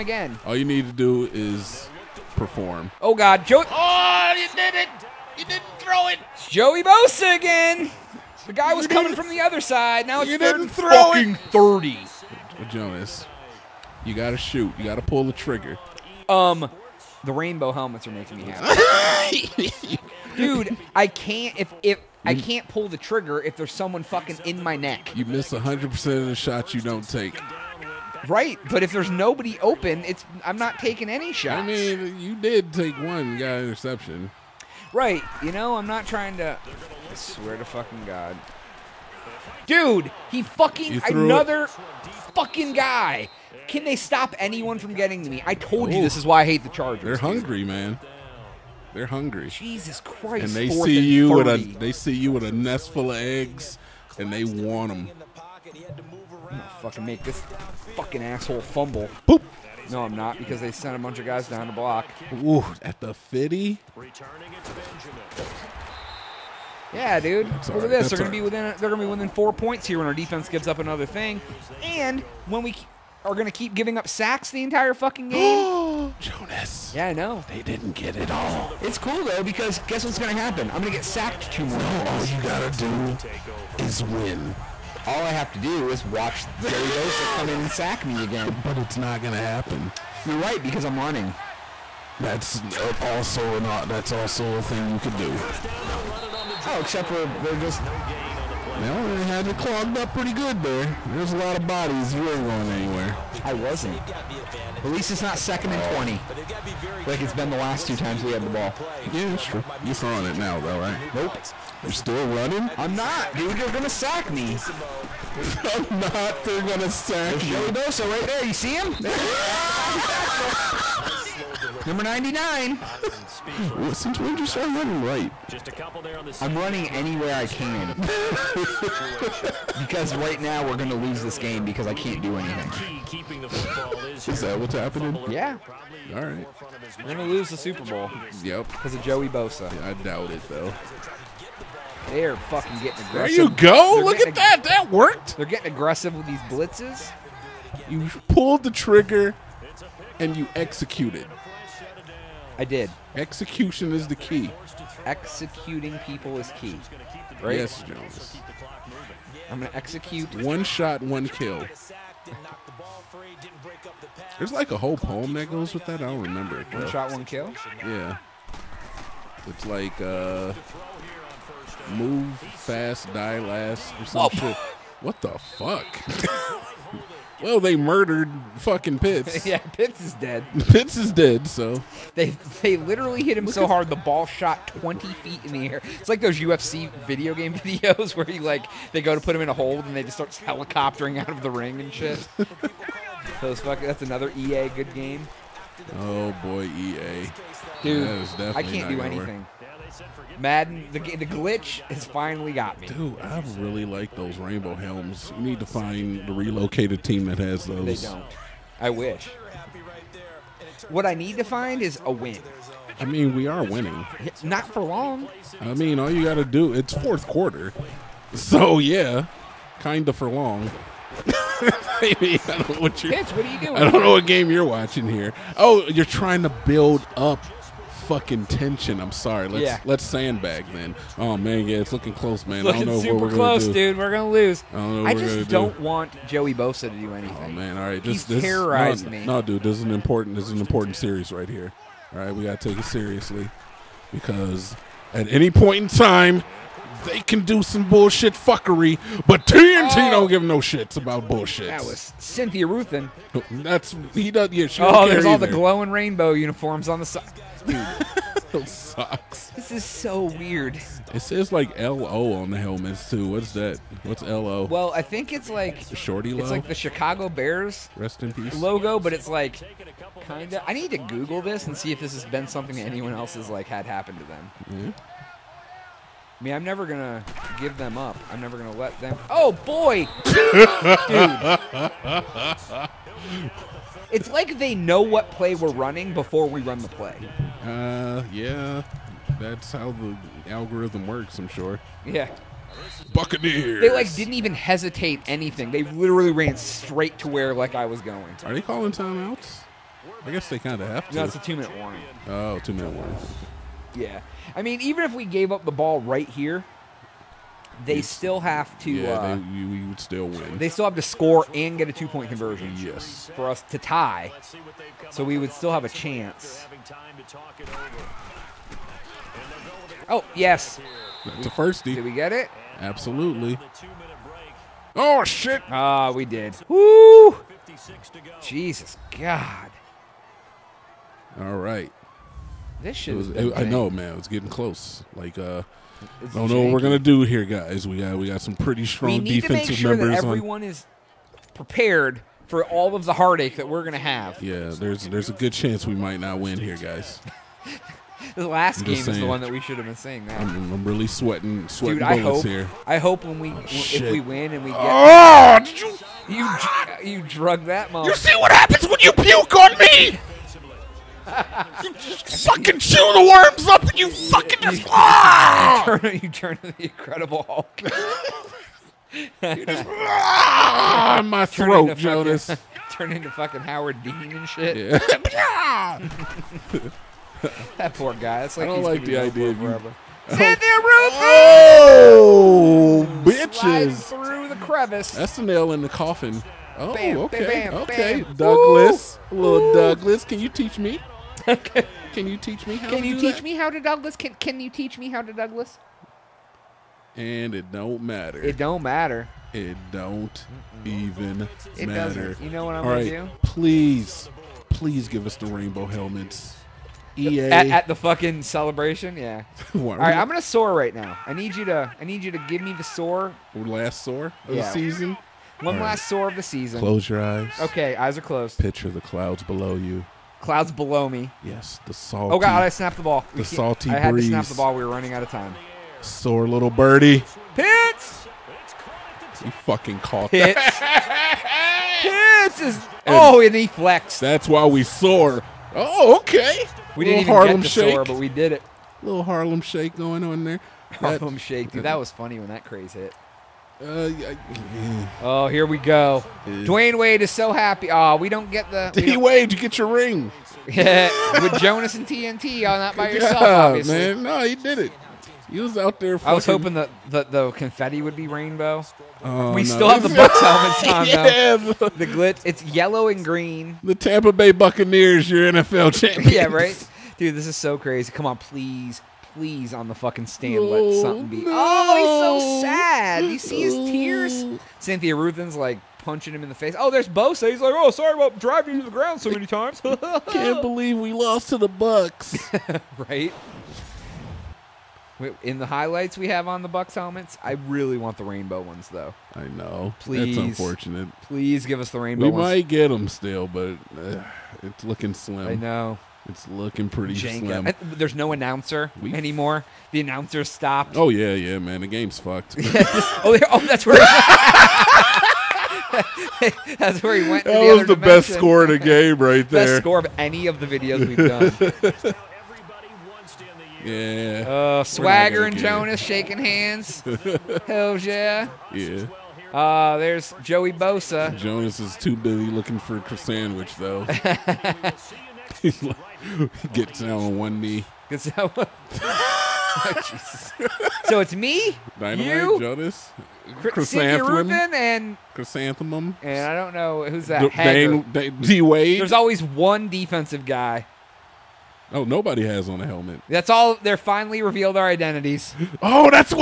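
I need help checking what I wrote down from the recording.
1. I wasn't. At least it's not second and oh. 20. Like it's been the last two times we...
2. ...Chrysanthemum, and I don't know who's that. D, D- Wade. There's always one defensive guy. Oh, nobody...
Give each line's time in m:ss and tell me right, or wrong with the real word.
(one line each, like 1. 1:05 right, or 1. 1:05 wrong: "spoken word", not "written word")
1. 1:43 right
2. 8:55 right.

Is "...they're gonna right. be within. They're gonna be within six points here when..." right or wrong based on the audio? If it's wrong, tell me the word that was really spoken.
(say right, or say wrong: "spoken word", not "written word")
wrong: "four", not "six".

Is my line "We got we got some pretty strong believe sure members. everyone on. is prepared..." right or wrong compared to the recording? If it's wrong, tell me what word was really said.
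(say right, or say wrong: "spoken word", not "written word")
wrong: "defensive", not "believe".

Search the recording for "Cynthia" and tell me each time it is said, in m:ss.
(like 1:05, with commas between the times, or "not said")
4:12, 6:20, 7:54.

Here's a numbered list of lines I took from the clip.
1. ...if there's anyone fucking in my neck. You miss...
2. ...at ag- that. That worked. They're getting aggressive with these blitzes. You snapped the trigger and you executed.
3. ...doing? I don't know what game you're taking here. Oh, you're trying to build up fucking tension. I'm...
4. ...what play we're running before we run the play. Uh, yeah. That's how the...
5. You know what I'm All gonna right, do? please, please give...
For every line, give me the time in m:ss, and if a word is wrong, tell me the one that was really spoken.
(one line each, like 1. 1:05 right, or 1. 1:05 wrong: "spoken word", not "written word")
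1. 0:23 wrong: "someone", not "anyone"
2. 2:24 wrong: "pulled", not "snapped"
3. 3:43 wrong: "watching", not "taking"
4. 4:45 right
5. 6:42 right.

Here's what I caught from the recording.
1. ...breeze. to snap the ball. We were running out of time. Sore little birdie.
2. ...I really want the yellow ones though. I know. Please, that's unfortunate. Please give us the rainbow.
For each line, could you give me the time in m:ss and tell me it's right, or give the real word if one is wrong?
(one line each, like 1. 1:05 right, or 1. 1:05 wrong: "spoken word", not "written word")
1. 7:04 right
2. 8:07 wrong: "rainbow", not "yellow".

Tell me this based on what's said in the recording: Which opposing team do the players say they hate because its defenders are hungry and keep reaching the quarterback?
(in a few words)
Chargers.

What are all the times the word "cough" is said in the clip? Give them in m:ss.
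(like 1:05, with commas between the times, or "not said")
not said.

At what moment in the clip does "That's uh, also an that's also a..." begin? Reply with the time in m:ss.
1:32.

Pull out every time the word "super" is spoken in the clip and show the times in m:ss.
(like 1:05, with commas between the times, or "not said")
2:17, 3:53.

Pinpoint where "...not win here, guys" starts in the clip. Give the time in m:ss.
5:46.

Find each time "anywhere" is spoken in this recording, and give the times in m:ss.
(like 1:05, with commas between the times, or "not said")
1:42, 2:06.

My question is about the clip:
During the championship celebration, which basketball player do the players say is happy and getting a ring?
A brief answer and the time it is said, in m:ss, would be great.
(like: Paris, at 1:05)
Dwayne Wade, at 7:26.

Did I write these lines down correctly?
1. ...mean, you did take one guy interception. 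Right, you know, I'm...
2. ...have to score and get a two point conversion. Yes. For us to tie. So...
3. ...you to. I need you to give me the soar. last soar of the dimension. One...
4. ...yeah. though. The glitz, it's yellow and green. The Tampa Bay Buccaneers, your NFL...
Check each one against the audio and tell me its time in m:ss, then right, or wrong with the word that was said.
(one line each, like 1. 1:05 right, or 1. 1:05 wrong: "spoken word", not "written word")
1. 0:31 right
2. 5:10 right
3. 6:51 wrong: "season", not "dimension"
4. 7:41 right.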